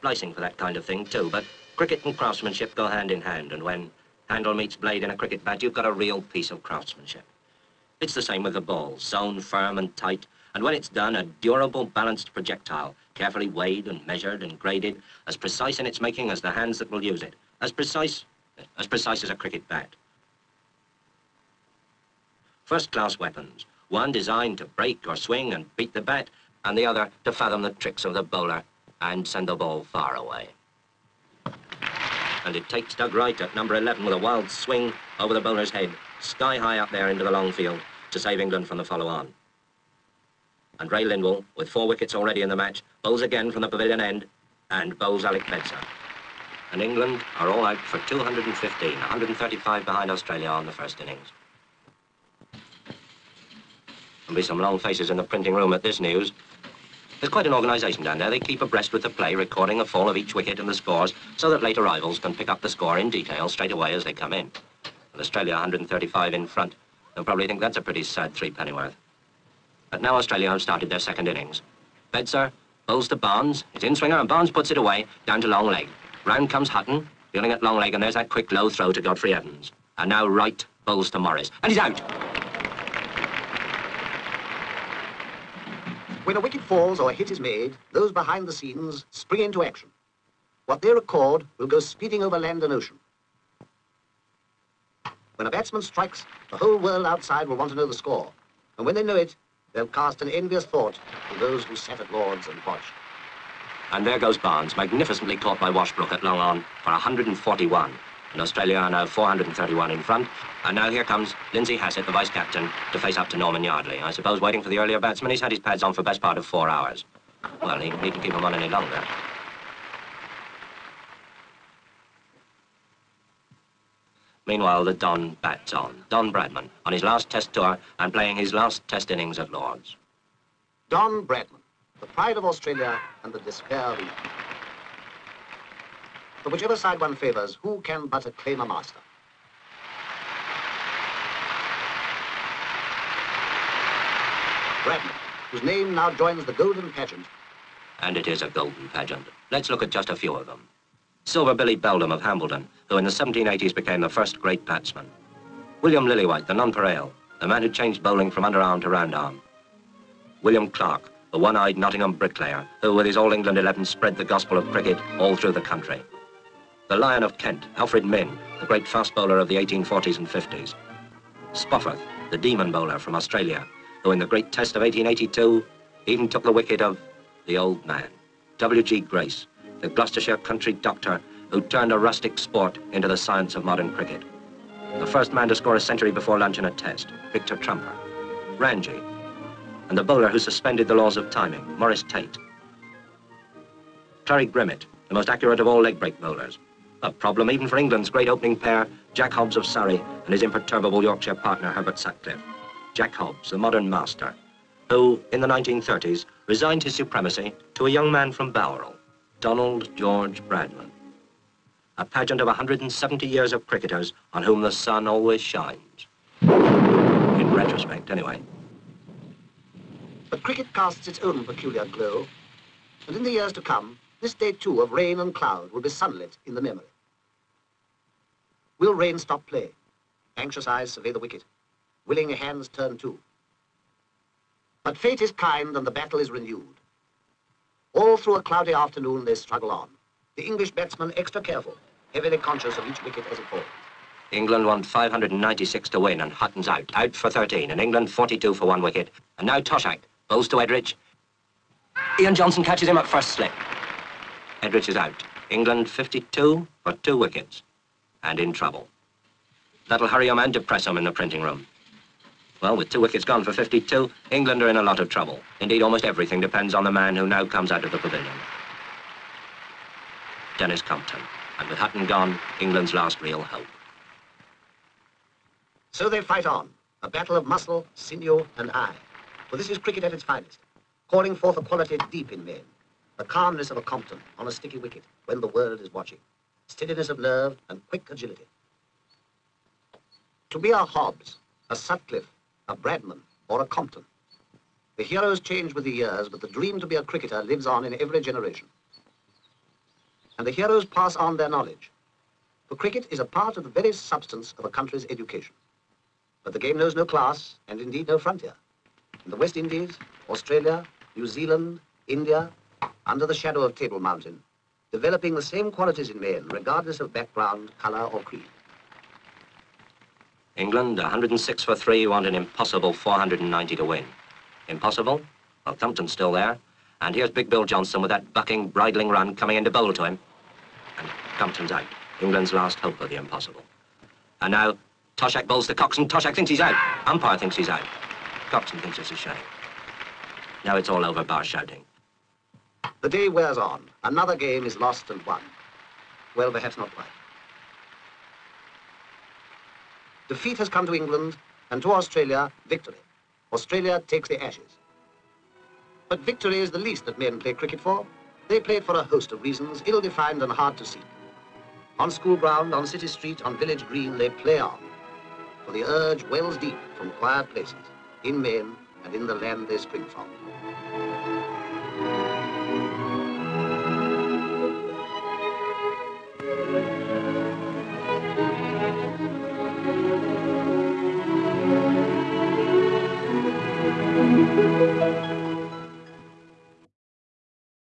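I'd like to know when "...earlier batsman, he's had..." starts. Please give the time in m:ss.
1:54.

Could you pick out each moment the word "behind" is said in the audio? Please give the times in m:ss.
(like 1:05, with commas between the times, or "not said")
0:49, 1:28.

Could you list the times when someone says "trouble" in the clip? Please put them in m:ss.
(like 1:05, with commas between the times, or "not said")
4:18, 4:25.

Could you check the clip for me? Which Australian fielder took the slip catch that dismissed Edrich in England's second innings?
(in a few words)
Ian Johnson.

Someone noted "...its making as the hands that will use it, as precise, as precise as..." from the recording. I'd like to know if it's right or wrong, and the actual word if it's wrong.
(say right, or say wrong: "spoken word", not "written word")
right.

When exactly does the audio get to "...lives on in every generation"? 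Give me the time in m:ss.
4:57.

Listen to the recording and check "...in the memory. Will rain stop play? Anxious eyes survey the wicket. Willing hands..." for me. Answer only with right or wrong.
right.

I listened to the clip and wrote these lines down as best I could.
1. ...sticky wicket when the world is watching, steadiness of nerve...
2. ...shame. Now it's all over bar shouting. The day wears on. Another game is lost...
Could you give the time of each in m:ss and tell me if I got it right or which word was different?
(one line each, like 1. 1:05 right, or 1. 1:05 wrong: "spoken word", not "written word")
1. 4:44 right
2. 5:39 right.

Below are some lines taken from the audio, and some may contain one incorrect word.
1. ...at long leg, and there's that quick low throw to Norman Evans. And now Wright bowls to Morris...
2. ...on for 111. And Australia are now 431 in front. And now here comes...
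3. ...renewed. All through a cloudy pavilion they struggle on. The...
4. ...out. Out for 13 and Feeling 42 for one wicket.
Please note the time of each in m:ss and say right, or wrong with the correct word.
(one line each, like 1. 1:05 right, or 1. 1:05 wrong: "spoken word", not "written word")
1. 1:17 wrong: "Godfrey", not "Norman"
2. 1:46 wrong: "141", not "111"
3. 3:56 wrong: "afternoon", not "pavilion"
4. 4:06 wrong: "England", not "Feeling".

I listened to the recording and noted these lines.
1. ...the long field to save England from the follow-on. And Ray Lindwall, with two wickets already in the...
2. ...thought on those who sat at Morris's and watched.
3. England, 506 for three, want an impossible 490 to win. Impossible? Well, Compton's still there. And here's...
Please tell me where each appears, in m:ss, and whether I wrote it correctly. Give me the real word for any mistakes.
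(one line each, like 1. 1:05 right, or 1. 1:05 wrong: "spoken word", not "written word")
1. 0:37 wrong: "four", not "two"
2. 1:40 wrong: "Lord", not "Morris"
3. 5:20 wrong: "106", not "506".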